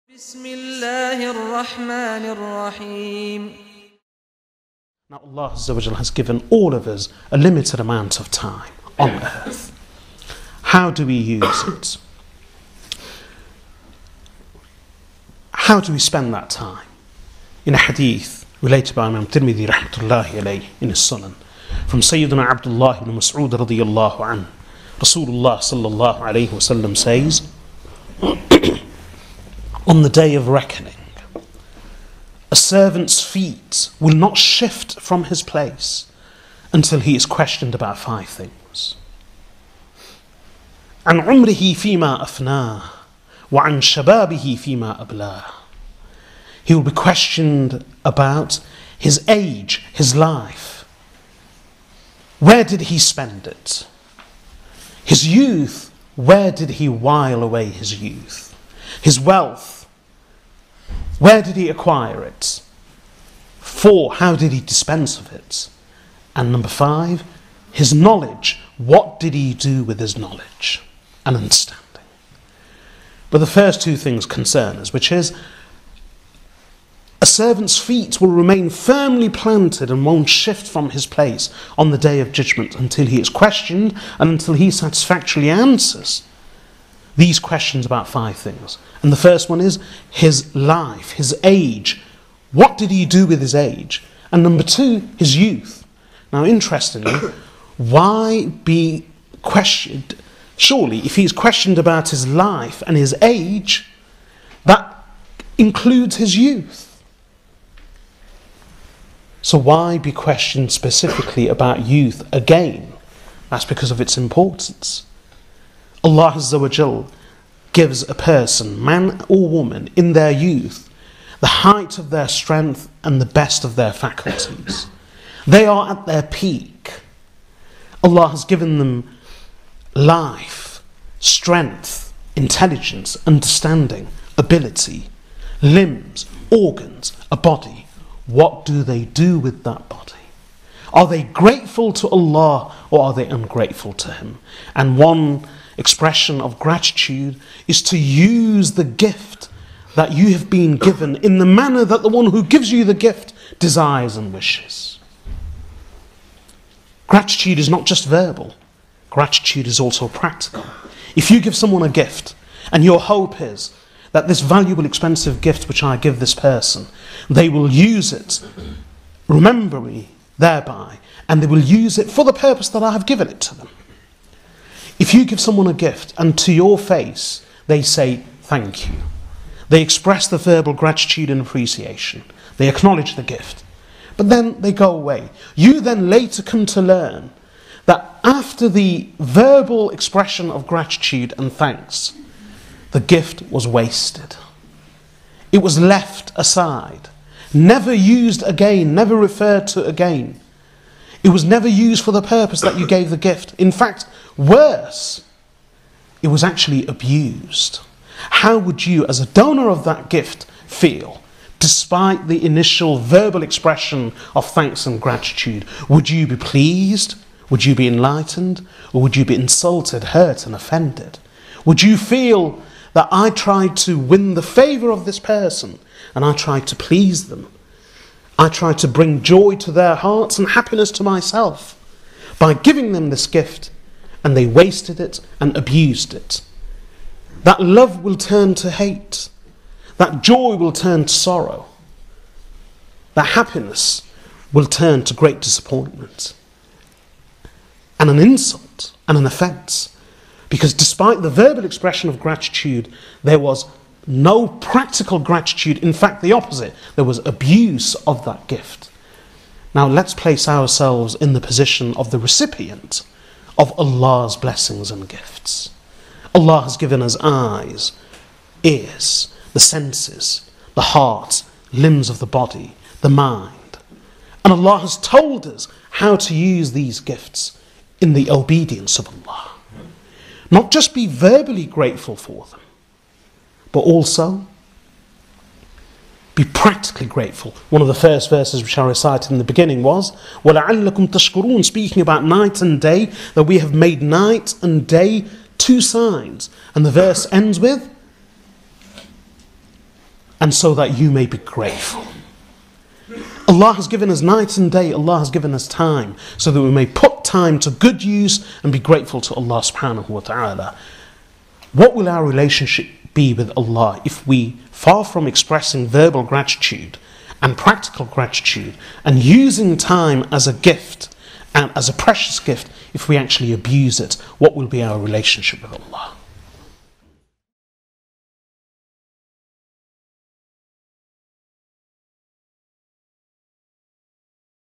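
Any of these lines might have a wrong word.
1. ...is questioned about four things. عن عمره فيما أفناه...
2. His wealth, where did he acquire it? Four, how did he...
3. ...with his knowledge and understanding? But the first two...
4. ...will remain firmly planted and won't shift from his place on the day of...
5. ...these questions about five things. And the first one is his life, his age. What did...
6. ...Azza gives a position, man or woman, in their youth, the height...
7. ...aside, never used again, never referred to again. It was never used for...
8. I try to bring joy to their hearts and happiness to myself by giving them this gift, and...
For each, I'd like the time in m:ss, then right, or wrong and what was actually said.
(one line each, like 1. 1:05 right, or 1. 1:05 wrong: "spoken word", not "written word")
1. 0:37 wrong: "five", not "four"
2. 0:59 right
3. 1:09 right
4. 1:18 right
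5. 1:27 right
6. 1:56 wrong: "person", not "position"
7. 3:16 right
8. 3:48 right.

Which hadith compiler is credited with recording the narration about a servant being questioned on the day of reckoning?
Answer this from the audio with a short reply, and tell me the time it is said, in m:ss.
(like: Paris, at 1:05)
Imam Tirmidhi, at 0:19.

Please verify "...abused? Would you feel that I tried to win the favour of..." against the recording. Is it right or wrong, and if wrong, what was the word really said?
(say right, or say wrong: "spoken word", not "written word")
wrong: "offended", not "abused".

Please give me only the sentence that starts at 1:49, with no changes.
So, why be questioned specifically about youth again?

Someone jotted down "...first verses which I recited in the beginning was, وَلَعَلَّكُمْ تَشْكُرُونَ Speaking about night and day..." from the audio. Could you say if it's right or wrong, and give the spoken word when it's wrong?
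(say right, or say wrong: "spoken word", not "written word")
right.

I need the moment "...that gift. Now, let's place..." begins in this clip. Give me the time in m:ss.
4:18.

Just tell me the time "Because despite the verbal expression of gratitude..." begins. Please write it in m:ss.
4:10.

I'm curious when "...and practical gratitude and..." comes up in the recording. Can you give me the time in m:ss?
5:17.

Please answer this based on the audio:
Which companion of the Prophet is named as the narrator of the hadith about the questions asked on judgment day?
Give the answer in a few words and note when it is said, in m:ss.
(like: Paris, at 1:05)
Abdullah ibn Mas'ud, at 0:22.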